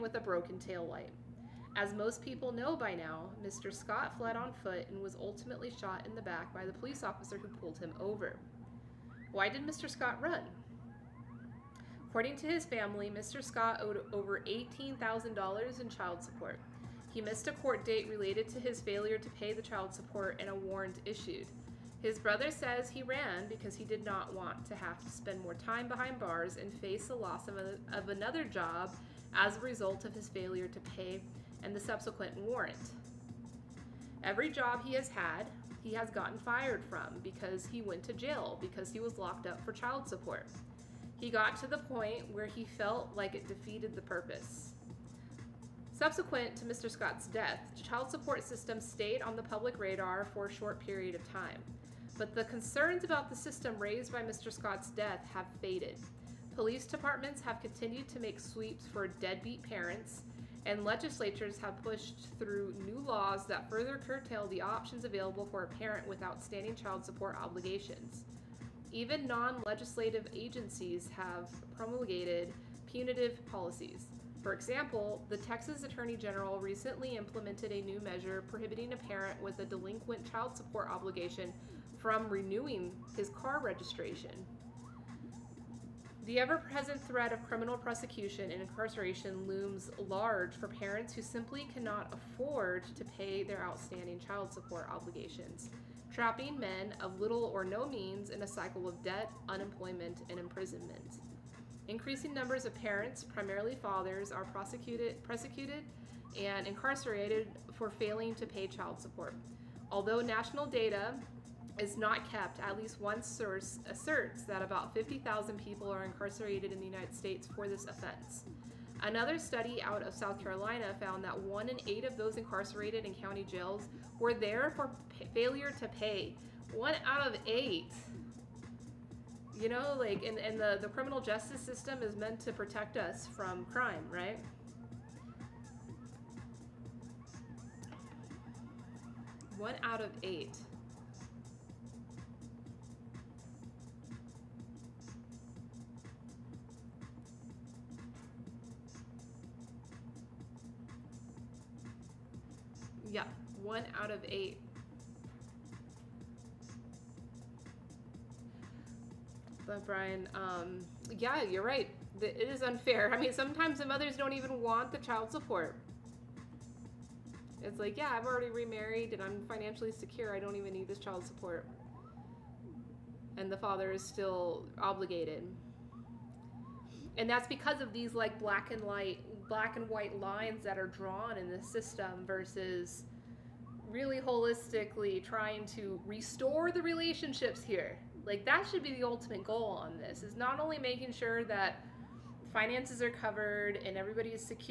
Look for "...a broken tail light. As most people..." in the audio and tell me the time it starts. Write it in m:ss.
0:00.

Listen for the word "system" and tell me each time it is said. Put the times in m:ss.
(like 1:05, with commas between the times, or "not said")
0:48, 0:53, 2:11, 3:01.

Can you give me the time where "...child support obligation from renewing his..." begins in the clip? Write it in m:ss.
1:20.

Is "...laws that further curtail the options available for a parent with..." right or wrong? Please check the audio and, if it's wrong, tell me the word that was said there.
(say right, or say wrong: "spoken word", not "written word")
right.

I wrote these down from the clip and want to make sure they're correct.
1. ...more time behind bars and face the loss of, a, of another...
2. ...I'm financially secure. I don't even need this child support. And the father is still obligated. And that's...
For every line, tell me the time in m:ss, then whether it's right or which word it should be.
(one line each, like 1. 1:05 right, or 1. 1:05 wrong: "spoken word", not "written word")
1. 0:25 right
2. 2:49 right.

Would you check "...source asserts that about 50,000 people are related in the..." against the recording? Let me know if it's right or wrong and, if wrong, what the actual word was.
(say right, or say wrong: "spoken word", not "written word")
wrong: "incarcerated", not "related".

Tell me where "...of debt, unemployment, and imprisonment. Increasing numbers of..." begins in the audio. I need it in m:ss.
1:38.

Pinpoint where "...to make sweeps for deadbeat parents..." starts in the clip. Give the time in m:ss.
0:58.